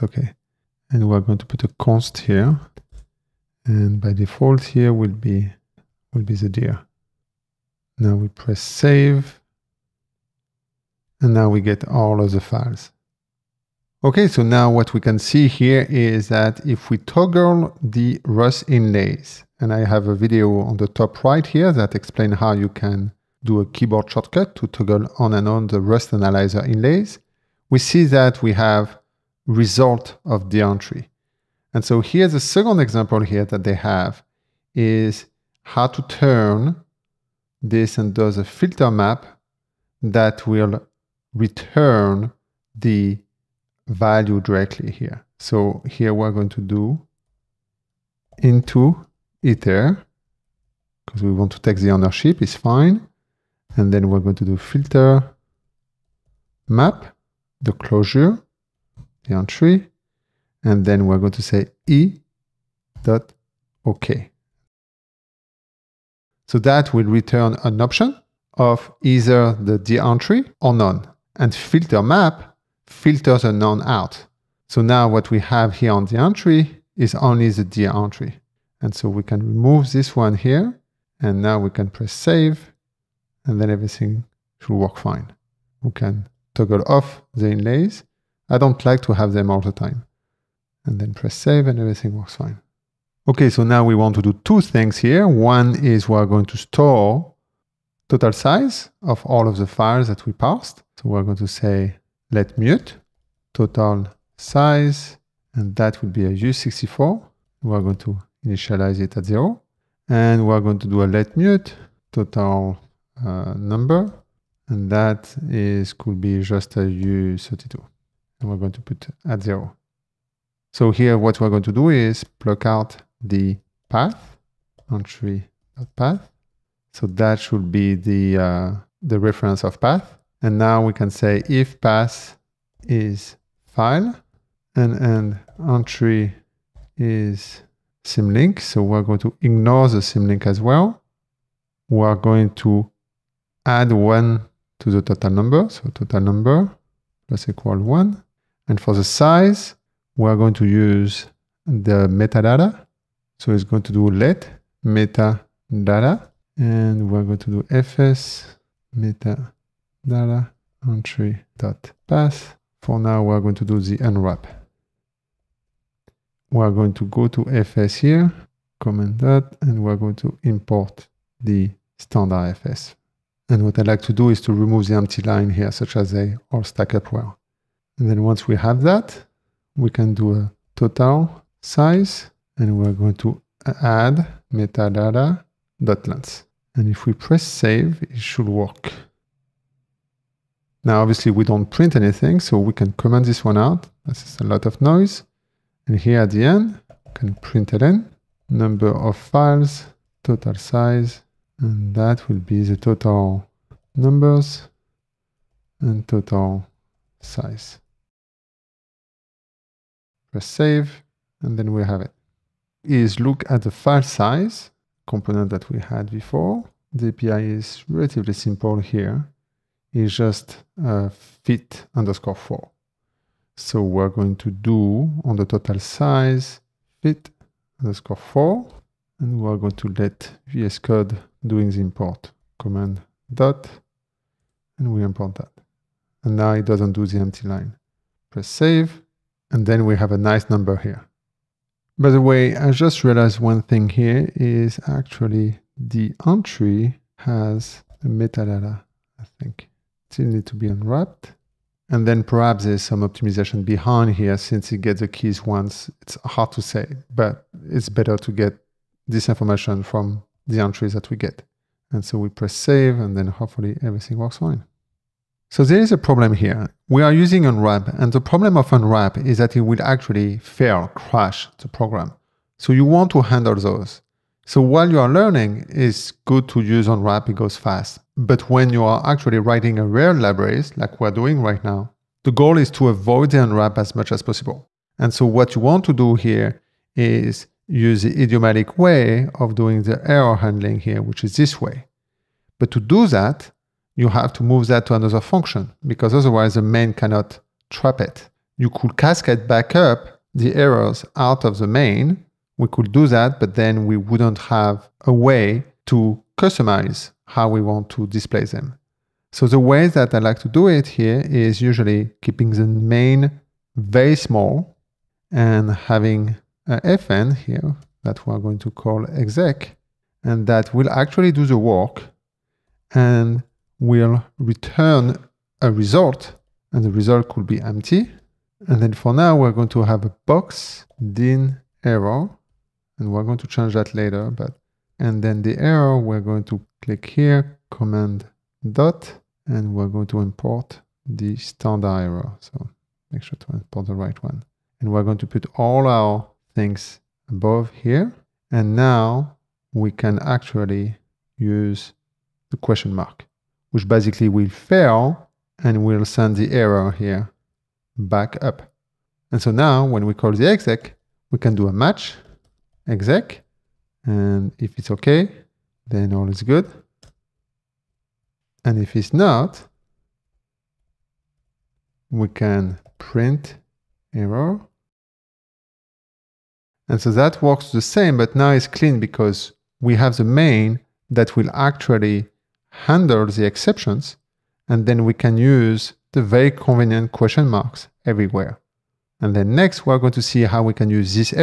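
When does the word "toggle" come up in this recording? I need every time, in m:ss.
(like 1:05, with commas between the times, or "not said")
0:16, 0:24, 1:26.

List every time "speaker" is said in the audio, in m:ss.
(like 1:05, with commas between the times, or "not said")
not said.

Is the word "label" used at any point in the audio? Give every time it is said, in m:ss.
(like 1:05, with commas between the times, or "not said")
not said.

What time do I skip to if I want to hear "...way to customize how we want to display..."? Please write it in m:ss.
5:05.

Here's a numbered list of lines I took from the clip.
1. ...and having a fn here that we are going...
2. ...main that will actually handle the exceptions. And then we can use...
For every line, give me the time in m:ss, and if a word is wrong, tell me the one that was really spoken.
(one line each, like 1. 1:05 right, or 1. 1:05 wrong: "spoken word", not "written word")
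1. 5:15 right
2. 6:20 right.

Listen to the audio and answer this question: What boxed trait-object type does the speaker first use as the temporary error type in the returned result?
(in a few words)
Box dyn Error.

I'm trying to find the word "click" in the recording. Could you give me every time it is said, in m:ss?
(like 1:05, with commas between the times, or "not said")
5:36.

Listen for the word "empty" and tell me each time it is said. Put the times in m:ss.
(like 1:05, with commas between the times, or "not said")
2:54, 3:57, 5:27.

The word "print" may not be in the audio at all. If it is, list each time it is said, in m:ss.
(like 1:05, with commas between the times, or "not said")
3:11, 3:17, 6:12.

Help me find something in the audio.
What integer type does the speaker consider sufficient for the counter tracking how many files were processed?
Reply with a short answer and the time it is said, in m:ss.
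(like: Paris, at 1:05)
u32, at 1:56.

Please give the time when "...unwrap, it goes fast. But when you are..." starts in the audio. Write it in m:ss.
4:36.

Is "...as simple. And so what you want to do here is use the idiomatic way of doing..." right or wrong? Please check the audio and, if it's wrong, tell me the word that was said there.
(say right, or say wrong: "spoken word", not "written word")
wrong: "possible", not "simple".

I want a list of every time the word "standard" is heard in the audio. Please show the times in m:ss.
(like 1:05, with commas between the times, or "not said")
2:51, 5:41.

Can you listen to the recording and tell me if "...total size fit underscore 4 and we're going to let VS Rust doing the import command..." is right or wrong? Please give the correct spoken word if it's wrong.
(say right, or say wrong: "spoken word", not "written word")
wrong: "Code", not "Rust".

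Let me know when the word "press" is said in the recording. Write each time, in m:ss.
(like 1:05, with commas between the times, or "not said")
0:08, 1:21, 1:31, 3:07, 3:30, 3:58, 4:22.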